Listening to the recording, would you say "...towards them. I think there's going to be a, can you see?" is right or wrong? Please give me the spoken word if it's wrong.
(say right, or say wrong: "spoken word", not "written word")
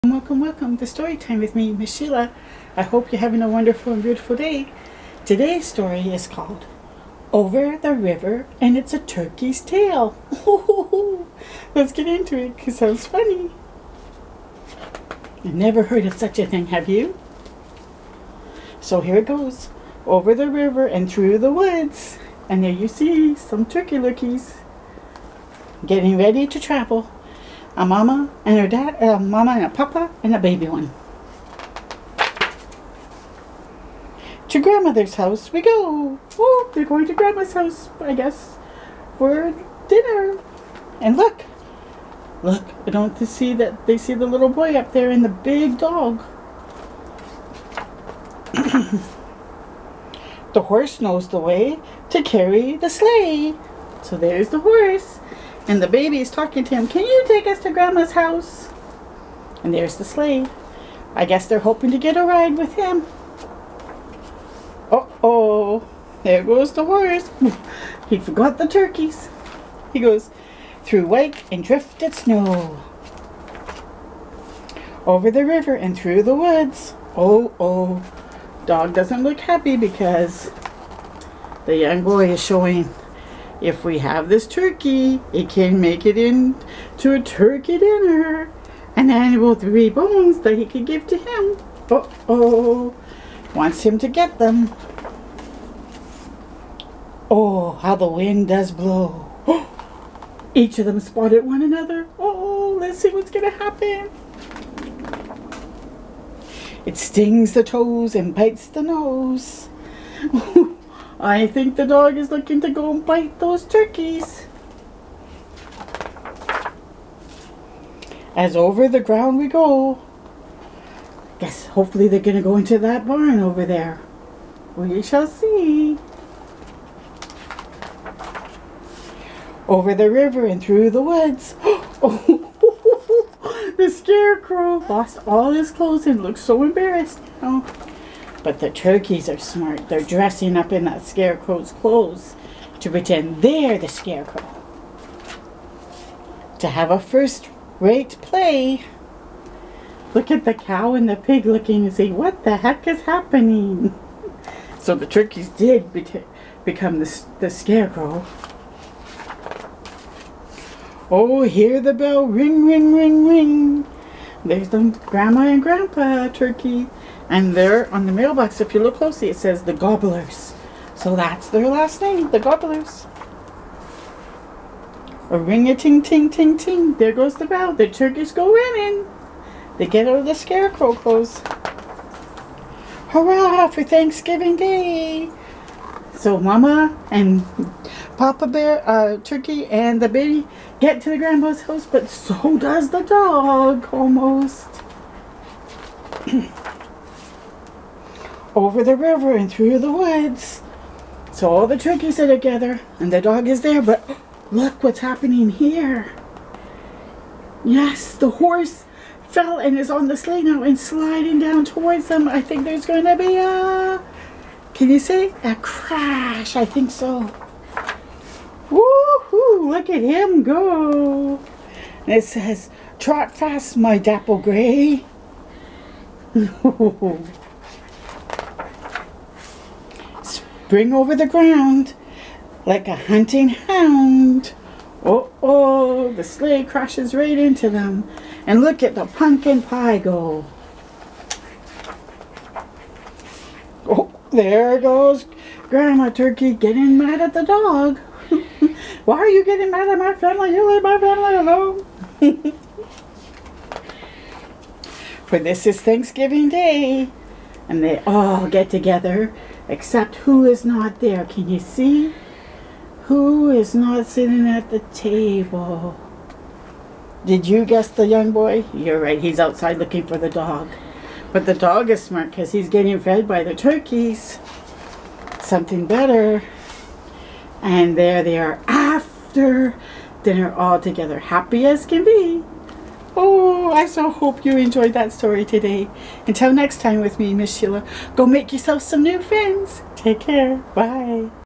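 right.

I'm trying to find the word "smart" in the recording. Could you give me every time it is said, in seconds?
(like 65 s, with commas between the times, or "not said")
139 s, 272 s.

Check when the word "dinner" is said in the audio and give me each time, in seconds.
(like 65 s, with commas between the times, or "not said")
39 s, 87 s, 280 s.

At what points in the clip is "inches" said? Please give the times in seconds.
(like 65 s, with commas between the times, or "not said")
not said.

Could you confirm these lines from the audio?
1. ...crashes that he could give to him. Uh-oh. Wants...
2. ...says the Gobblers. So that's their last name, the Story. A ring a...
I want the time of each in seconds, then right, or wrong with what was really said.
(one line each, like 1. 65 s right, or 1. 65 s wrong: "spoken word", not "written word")
1. 89 s wrong: "bones", not "crashes"
2. 169 s wrong: "Gobblers", not "Story".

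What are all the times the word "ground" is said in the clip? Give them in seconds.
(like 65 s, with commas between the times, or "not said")
119 s, 231 s.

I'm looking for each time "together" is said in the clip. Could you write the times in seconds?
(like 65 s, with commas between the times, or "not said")
202 s, 258 s, 280 s.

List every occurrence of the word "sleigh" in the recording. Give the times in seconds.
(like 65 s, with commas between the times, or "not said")
52 s, 60 s, 210 s, 236 s.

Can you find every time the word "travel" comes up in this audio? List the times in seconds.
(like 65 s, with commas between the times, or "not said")
26 s.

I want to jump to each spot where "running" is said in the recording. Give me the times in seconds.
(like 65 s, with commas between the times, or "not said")
178 s.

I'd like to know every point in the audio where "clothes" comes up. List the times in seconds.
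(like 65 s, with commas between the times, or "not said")
135 s, 141 s, 180 s.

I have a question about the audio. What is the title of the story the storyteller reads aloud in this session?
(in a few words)
Over the River and It's a Turkey's Tale.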